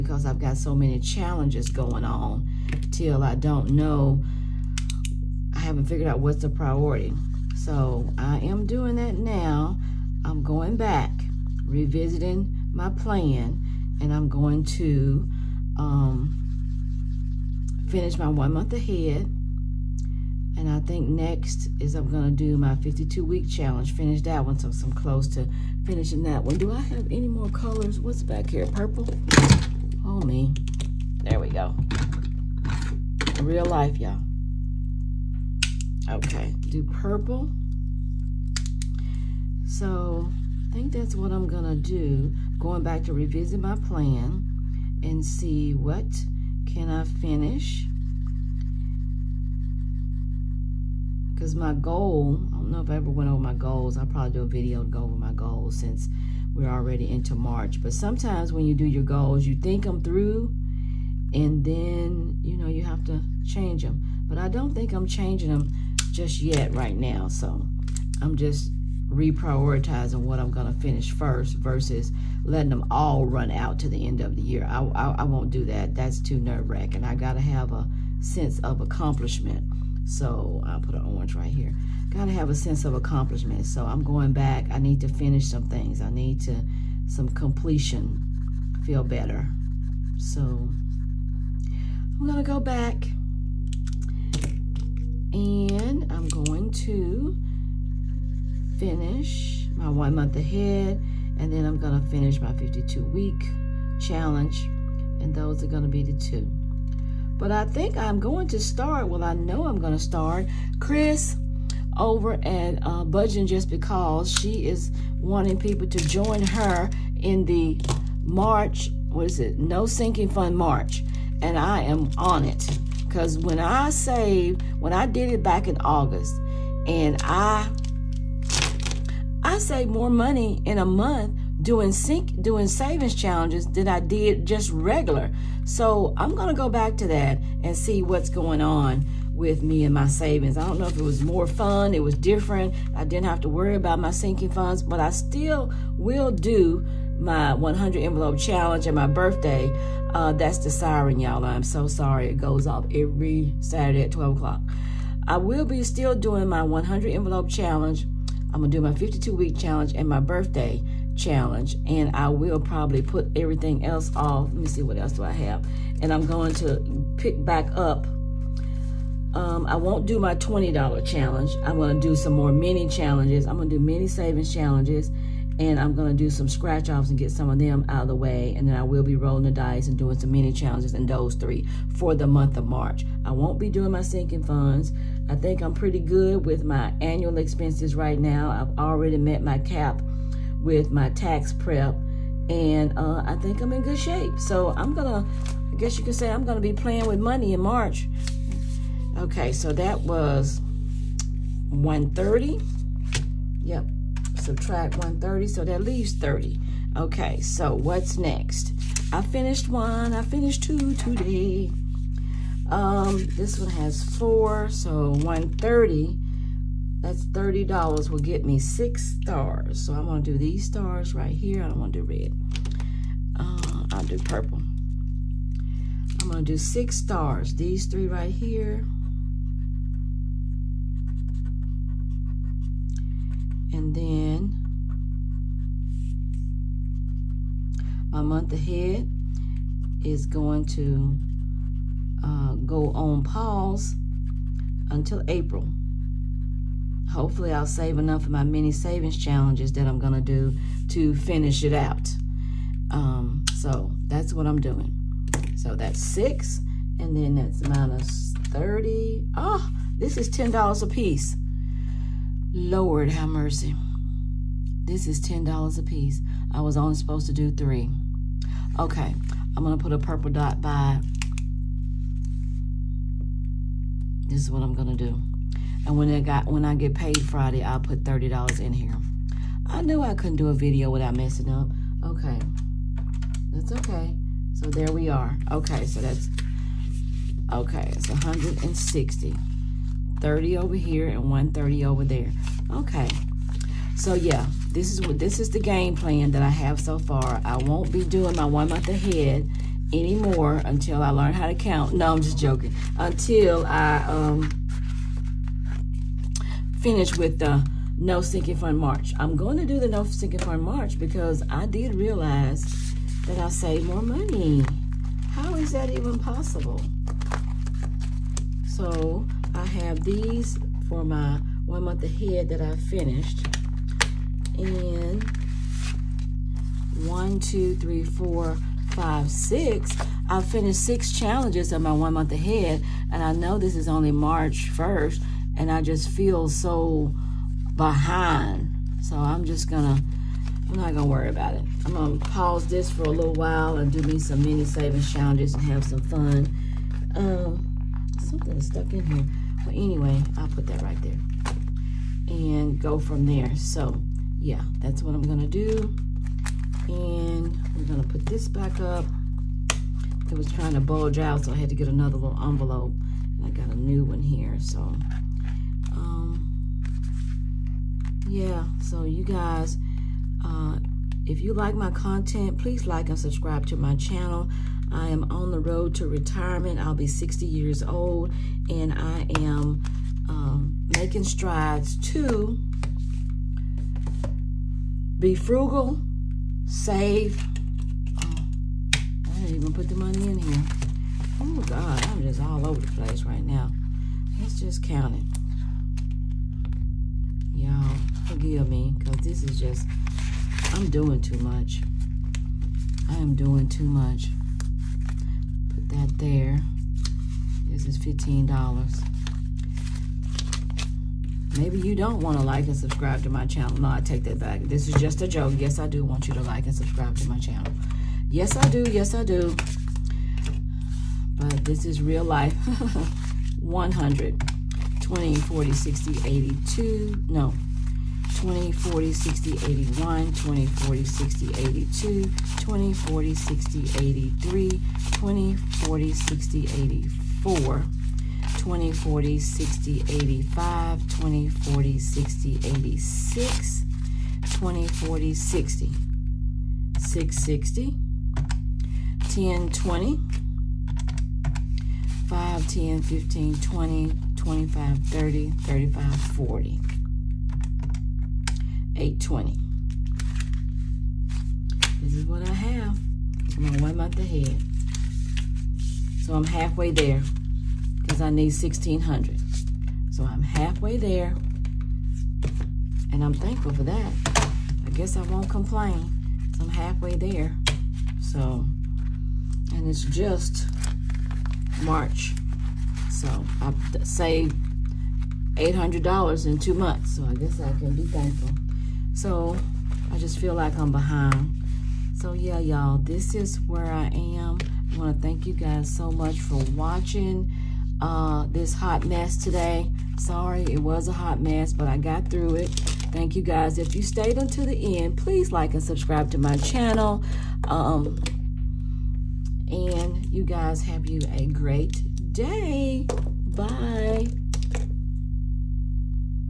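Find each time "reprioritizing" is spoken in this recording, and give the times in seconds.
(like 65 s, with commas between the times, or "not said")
69 s.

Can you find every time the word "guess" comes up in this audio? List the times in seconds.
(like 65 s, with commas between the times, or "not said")
195 s, 474 s, 487 s.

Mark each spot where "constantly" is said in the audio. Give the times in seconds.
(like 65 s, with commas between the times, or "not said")
not said.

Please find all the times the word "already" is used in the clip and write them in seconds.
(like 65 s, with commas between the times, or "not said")
56 s, 188 s.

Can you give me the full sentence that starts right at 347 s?
Um, Something is stuck in here.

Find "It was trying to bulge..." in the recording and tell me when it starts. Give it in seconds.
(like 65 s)
360 s.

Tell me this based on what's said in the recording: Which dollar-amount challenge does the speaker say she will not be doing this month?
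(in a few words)
$20 challenge.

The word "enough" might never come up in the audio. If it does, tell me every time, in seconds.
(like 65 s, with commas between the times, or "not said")
247 s.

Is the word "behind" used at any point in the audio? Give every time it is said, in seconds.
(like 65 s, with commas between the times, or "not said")
337 s, 490 s.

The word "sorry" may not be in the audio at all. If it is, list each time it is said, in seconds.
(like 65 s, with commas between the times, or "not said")
151 s, 500 s.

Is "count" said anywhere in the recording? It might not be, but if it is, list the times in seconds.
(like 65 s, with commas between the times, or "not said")
301 s, 394 s.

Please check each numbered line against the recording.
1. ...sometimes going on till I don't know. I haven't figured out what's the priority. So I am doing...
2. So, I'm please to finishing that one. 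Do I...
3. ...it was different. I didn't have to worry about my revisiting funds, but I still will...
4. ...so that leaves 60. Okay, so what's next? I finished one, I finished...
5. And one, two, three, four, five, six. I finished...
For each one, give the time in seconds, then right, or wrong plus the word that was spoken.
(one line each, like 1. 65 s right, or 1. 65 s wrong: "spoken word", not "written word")
1. 0 s wrong: "challenges", not "sometimes"
2. 24 s wrong: "close", not "please"
3. 141 s wrong: "sinking", not "revisiting"
4. 205 s wrong: "30", not "60"
5. 324 s right.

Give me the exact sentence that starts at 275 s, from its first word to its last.
And when I got when I get paid Friday, I'll put $30 in here.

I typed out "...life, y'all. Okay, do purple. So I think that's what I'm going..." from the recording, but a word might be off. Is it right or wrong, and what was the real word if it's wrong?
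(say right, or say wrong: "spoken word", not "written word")
right.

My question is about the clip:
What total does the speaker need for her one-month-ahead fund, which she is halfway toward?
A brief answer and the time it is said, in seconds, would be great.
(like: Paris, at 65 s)
1600, at 468 s.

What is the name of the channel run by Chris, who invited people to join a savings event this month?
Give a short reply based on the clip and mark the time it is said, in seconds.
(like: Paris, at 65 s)
Budgeting Just Because, at 113 s.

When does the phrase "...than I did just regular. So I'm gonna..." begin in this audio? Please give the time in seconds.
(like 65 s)
133 s.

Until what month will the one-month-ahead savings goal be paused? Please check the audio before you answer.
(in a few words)
April.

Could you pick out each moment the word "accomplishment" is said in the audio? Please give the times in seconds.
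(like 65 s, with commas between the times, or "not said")
78 s, 82 s.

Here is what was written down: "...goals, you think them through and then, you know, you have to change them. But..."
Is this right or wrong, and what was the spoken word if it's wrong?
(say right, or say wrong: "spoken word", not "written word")
right.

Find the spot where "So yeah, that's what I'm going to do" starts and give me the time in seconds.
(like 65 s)
353 s.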